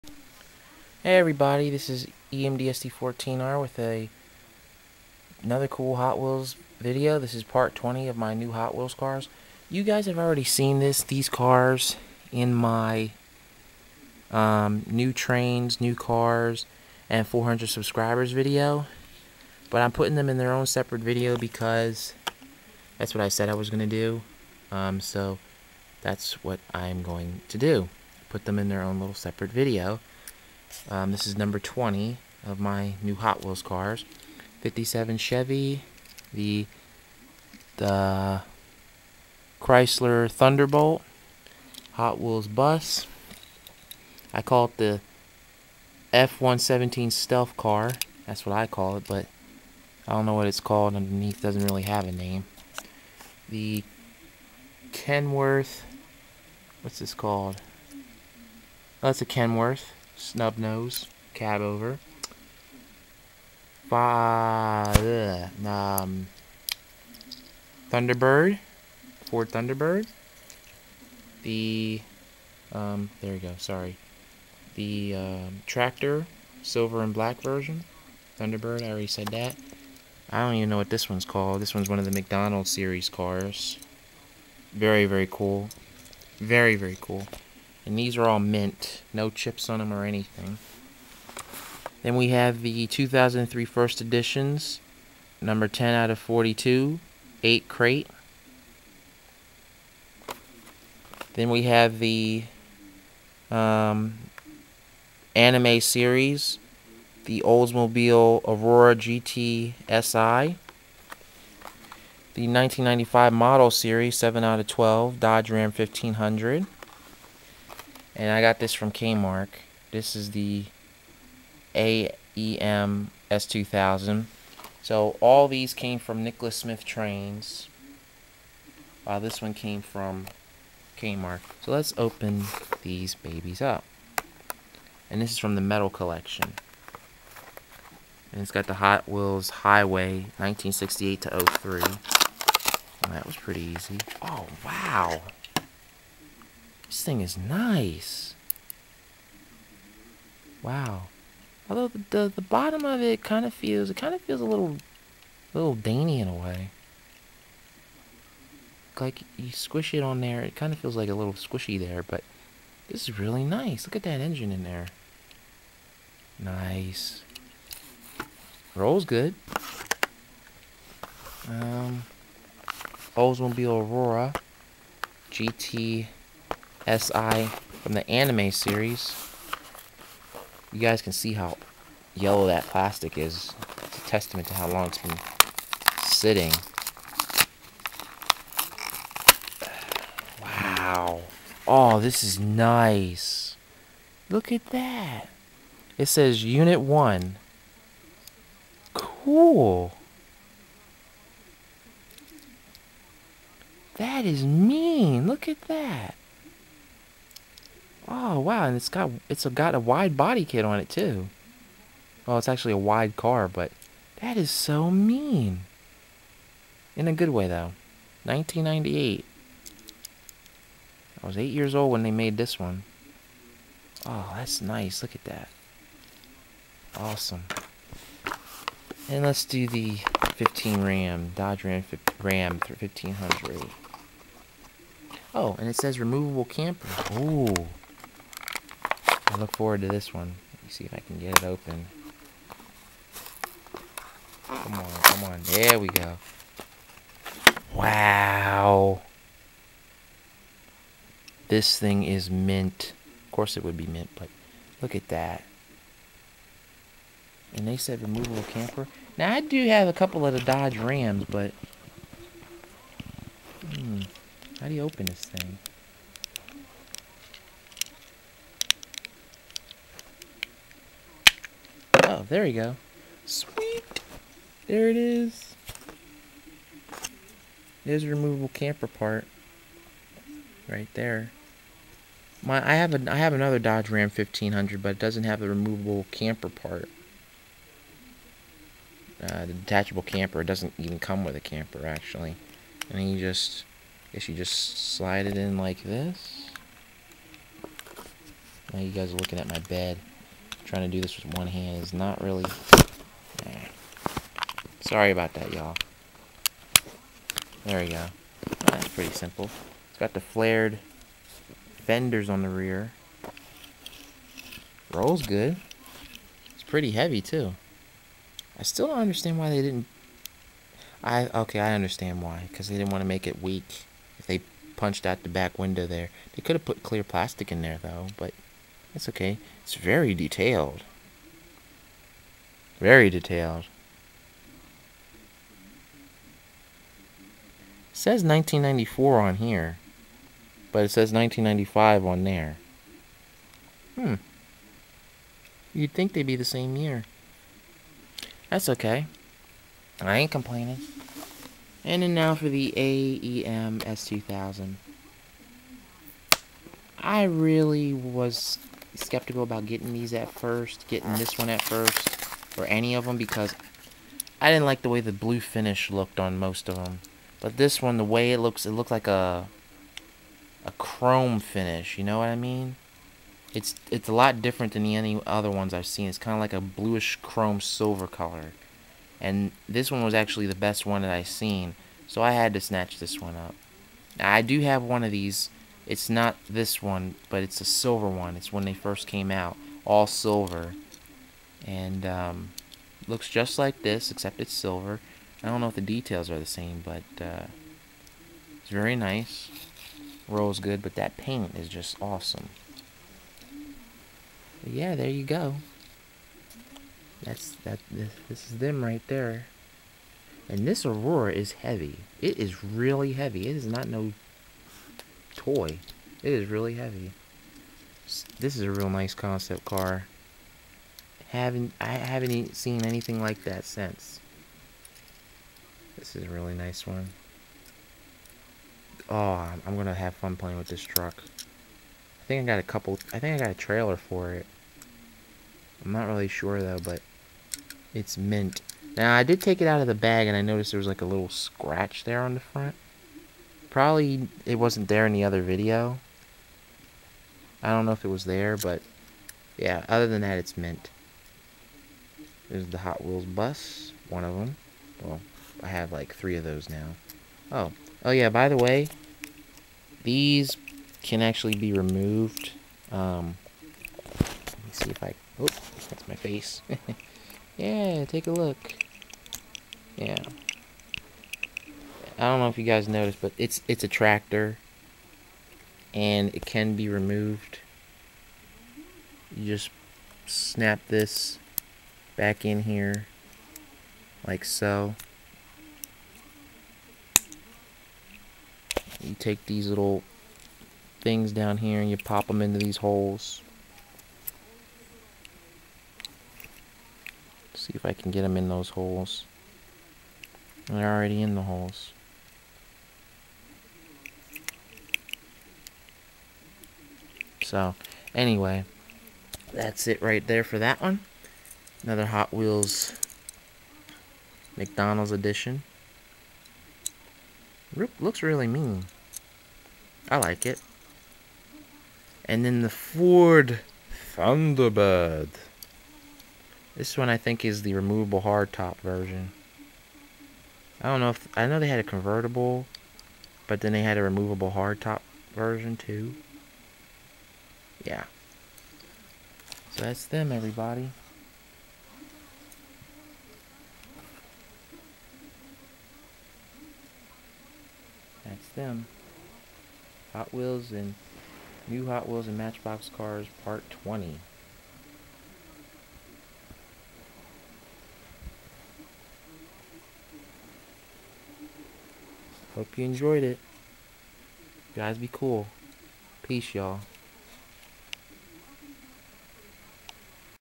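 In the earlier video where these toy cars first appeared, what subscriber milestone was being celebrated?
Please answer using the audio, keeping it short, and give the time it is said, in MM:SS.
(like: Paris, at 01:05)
400, at 00:17.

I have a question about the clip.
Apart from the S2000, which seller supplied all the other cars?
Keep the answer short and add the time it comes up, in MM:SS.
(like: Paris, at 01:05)
Nicholas Smith Trains, at 02:06.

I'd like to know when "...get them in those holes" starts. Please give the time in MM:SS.
08:18.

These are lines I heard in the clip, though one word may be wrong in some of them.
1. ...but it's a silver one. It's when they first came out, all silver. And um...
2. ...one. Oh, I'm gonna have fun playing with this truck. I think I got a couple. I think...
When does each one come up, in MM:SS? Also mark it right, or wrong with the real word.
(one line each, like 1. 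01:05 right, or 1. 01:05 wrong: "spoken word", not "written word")
1. 06:27 right
2. 07:06 right.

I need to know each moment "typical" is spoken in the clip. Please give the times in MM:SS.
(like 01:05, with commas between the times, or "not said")
not said.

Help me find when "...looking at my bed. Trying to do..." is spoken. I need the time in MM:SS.
04:59.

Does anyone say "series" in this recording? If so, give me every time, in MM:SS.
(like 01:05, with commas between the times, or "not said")
01:22, 01:45, 01:53, 02:58.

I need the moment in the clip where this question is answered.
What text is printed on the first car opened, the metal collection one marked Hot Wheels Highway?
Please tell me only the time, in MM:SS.
03:16.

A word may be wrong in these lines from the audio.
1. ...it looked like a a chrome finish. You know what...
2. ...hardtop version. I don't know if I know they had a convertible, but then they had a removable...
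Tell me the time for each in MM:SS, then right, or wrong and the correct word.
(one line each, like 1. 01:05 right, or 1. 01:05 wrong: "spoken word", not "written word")
1. 06:08 right
2. 08:48 right.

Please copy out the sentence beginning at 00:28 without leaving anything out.
Put them in their own little separate video um, this is number 20 of my new Hot Wheels cars.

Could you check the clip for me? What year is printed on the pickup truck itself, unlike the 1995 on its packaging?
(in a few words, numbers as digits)
1994.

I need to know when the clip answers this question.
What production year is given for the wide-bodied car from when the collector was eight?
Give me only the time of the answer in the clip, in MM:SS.
03:38.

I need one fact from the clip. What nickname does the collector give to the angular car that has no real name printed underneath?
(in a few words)
F-117 stealth car.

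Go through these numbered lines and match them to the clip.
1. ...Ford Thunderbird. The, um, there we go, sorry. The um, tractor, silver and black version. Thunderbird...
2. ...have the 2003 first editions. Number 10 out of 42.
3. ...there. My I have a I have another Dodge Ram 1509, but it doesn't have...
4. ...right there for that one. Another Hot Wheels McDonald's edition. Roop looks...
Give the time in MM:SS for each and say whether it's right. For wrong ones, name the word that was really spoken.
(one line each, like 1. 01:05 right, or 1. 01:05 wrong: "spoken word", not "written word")
1. 01:09 right
2. 01:32 right
3. 04:40 wrong: "1500", not "1509"
4. 08:30 right.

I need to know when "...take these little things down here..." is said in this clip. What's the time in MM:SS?
08:09.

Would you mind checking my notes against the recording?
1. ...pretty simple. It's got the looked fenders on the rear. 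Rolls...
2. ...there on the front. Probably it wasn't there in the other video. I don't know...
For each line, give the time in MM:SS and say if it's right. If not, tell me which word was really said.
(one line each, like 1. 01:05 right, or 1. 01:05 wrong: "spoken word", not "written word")
1. 05:08 wrong: "flared", not "looked"
2. 07:22 right.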